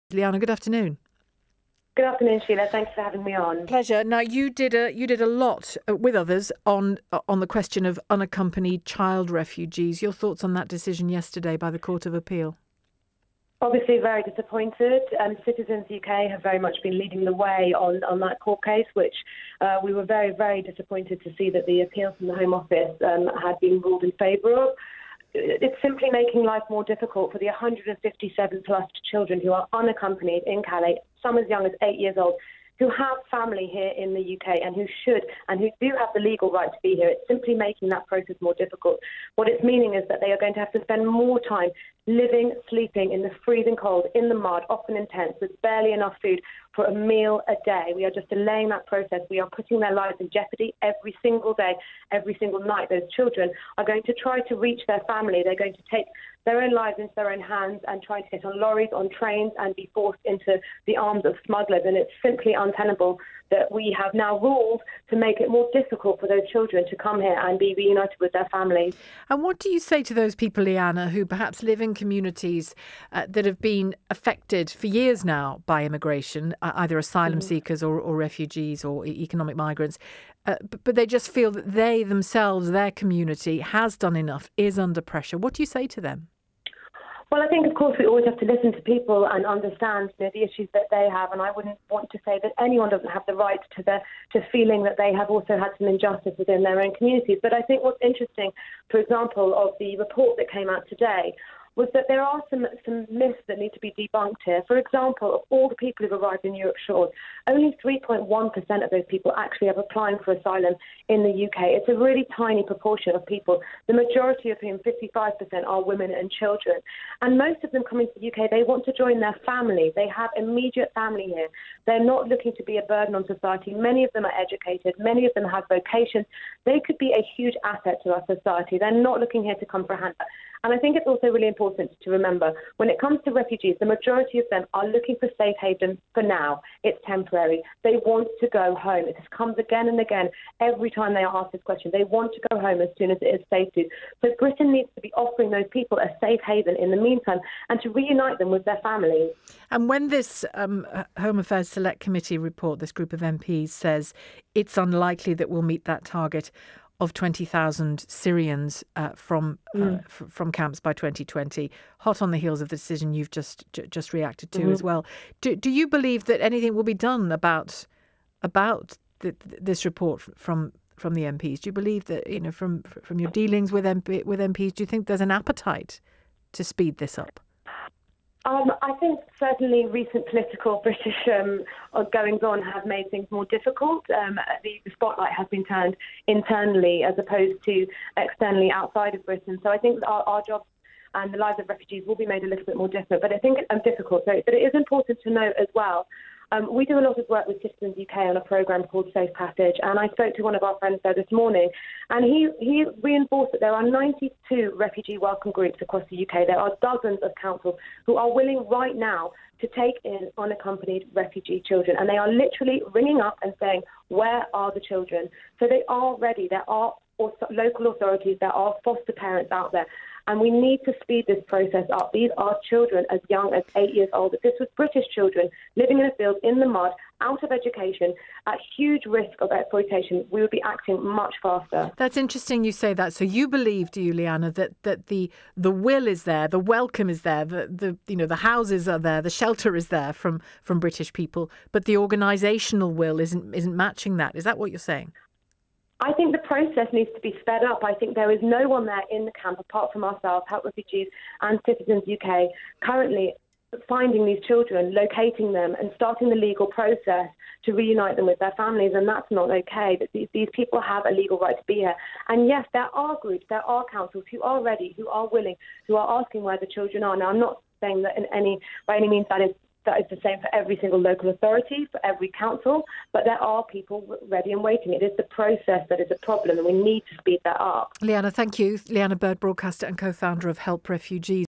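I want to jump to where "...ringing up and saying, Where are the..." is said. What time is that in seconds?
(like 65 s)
212 s.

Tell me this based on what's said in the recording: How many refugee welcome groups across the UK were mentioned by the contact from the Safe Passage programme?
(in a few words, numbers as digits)
92.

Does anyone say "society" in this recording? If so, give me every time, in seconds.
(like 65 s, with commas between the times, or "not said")
123 s, 128 s.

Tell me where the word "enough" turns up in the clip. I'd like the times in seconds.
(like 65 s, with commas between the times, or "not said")
45 s, 84 s.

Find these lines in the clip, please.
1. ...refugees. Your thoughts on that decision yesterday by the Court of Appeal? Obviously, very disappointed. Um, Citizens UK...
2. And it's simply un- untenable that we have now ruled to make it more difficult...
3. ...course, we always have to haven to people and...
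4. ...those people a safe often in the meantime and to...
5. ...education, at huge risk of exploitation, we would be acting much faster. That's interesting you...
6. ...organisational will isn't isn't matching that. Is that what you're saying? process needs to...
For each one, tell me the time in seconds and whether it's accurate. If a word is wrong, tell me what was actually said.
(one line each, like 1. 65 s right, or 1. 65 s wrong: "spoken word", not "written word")
1. 9 s right
2. 61 s right
3. 87 s wrong: "listen", not "haven"
4. 145 s wrong: "haven", not "often"
5. 227 s right
6. 241 s right.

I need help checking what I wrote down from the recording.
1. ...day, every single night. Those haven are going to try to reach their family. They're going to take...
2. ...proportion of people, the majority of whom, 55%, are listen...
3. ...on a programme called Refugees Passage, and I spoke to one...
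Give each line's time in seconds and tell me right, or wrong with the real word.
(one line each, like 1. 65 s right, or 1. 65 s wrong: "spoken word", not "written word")
1. 51 s wrong: "children", not "haven"
2. 112 s wrong: "women", not "listen"
3. 198 s wrong: "Safe", not "Refugees".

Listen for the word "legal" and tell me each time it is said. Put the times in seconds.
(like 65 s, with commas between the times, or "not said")
36 s, 256 s, 261 s.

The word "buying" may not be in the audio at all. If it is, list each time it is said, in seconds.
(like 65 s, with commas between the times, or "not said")
not said.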